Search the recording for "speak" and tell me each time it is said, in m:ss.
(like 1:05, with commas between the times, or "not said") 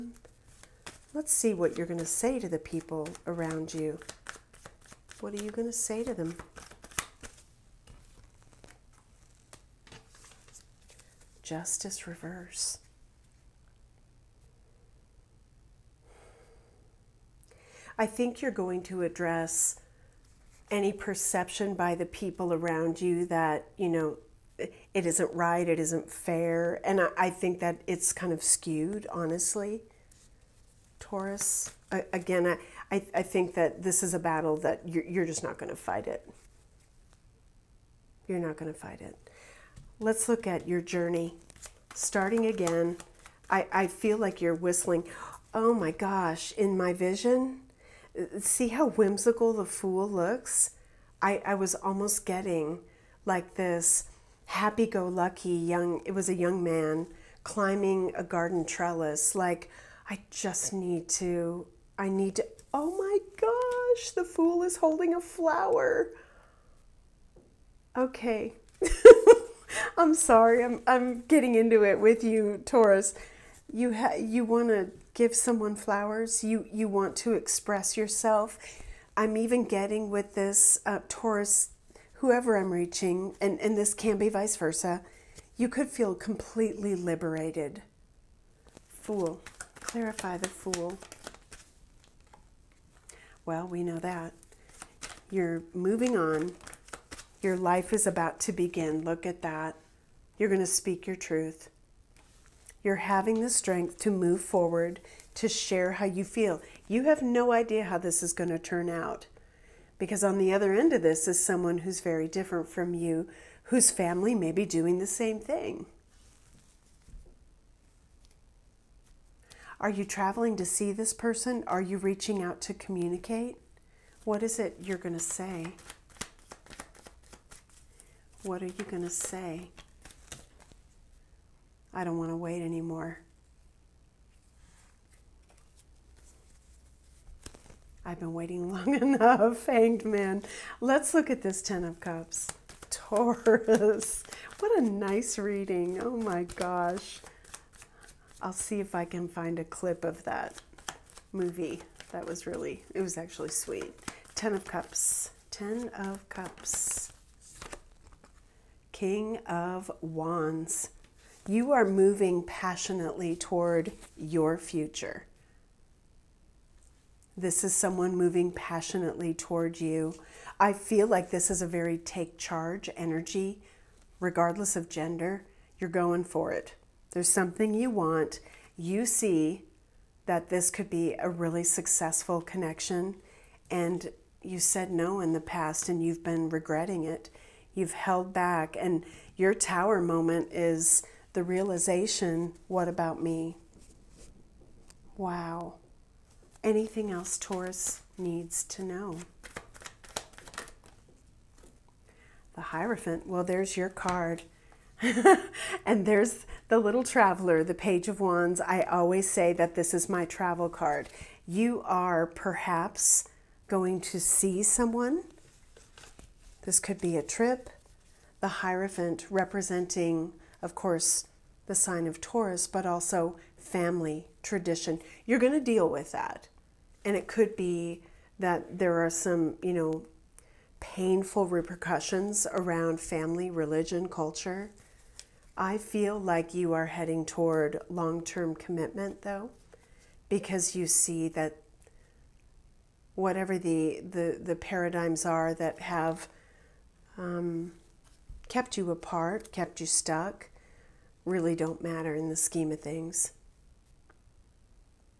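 1:40.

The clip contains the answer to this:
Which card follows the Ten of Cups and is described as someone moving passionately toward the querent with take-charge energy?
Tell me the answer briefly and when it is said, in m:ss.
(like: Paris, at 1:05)
King of Wands, at 2:39.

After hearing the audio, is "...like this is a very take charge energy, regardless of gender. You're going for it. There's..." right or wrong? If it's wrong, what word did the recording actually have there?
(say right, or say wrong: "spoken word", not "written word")
right.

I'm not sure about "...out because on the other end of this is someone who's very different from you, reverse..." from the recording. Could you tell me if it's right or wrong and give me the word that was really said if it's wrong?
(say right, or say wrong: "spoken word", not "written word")
wrong: "whose", not "reverse".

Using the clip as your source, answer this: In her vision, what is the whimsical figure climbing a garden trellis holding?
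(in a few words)
A flower.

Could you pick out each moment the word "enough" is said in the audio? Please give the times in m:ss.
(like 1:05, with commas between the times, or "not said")
2:18.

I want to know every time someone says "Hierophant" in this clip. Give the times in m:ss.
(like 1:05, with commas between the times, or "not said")
3:22, 3:38.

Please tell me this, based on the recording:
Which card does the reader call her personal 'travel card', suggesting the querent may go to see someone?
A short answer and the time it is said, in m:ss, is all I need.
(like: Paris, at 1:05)
Page of Wands, at 3:27.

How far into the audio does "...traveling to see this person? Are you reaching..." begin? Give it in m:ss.
2:00.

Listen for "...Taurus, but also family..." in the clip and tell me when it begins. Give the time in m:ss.
3:42.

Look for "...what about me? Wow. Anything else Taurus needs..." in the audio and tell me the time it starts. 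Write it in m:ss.
3:12.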